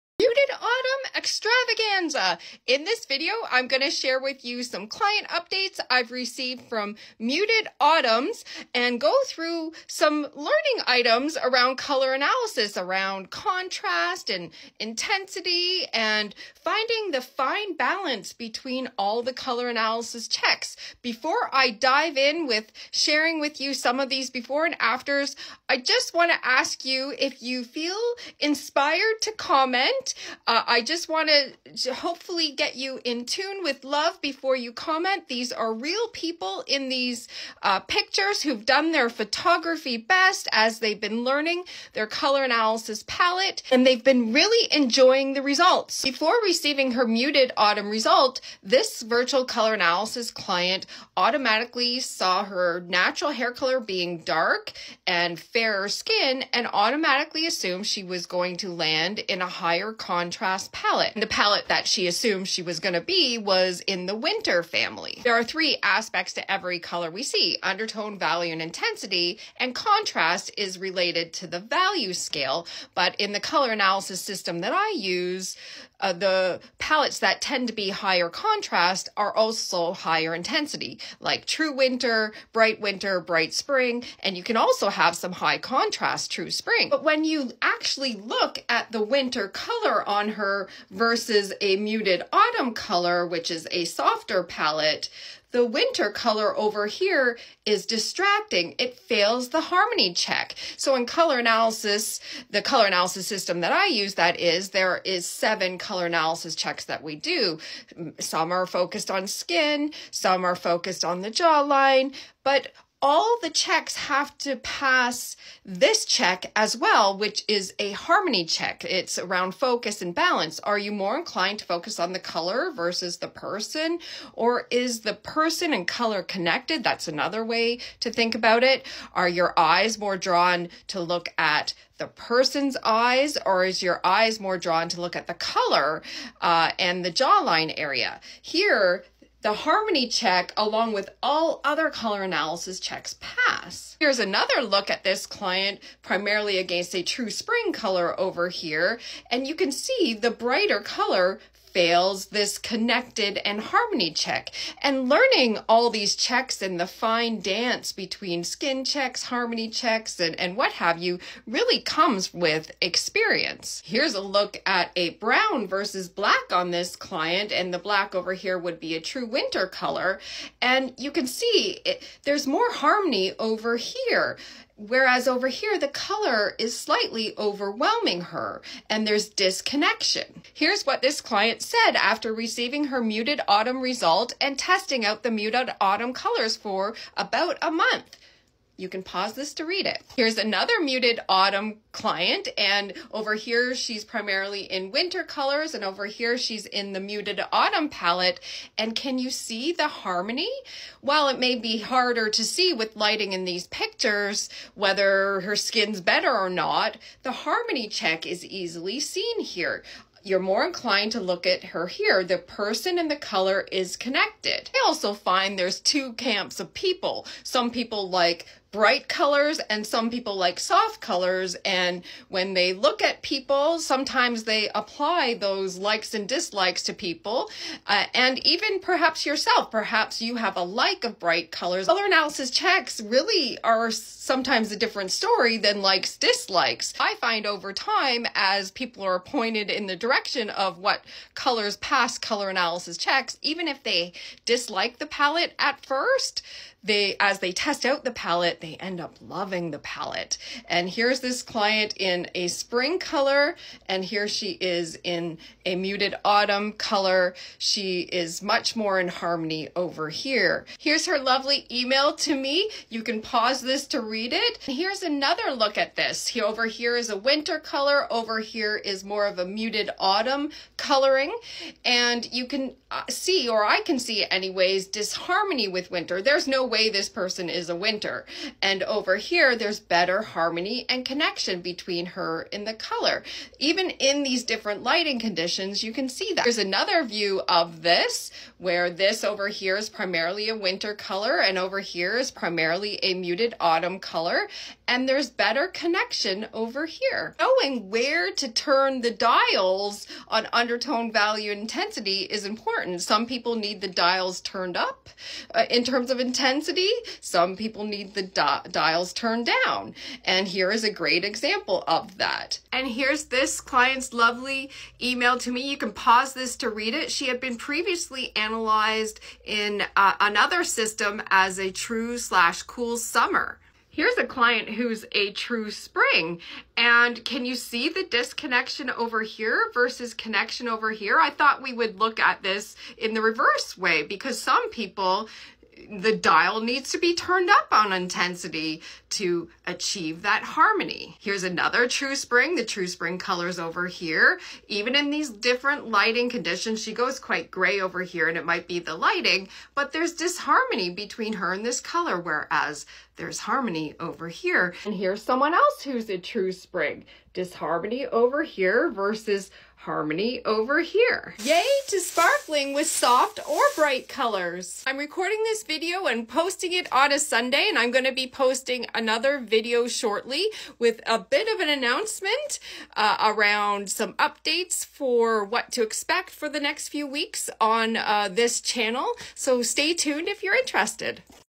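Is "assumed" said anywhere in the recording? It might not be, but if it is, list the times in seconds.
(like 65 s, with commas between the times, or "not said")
57 s, 62 s.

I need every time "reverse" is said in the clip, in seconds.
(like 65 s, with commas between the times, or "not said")
333 s.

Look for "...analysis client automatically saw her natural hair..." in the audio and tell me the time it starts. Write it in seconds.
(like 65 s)
49 s.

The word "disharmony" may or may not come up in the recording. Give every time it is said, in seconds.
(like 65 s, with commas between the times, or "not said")
274 s, 350 s, 357 s.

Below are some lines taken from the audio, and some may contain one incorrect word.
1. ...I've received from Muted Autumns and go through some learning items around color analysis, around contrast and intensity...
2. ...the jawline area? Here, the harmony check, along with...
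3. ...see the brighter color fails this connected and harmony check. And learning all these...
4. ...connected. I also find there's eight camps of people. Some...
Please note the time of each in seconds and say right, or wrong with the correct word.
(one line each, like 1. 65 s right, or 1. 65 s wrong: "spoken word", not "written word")
1. 5 s right
2. 137 s right
3. 149 s right
4. 213 s wrong: "two", not "eight".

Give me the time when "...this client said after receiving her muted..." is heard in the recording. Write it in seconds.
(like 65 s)
181 s.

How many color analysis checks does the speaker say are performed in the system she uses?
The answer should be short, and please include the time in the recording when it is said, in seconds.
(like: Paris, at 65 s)
7, at 105 s.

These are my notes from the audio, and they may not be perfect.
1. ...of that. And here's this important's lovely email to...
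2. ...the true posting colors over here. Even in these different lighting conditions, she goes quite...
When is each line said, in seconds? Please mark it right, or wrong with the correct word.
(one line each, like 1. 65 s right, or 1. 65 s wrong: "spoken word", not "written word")
1. 311 s wrong: "client", not "important"
2. 342 s wrong: "spring", not "posting".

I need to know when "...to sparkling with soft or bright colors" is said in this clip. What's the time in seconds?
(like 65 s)
361 s.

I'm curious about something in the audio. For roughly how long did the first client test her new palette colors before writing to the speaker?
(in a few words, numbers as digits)
about a month.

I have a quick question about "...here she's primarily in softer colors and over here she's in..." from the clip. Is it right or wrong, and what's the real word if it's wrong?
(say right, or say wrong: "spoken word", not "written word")
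wrong: "winter", not "softer".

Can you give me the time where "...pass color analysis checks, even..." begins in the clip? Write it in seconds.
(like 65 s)
241 s.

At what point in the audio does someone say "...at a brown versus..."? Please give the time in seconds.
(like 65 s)
164 s.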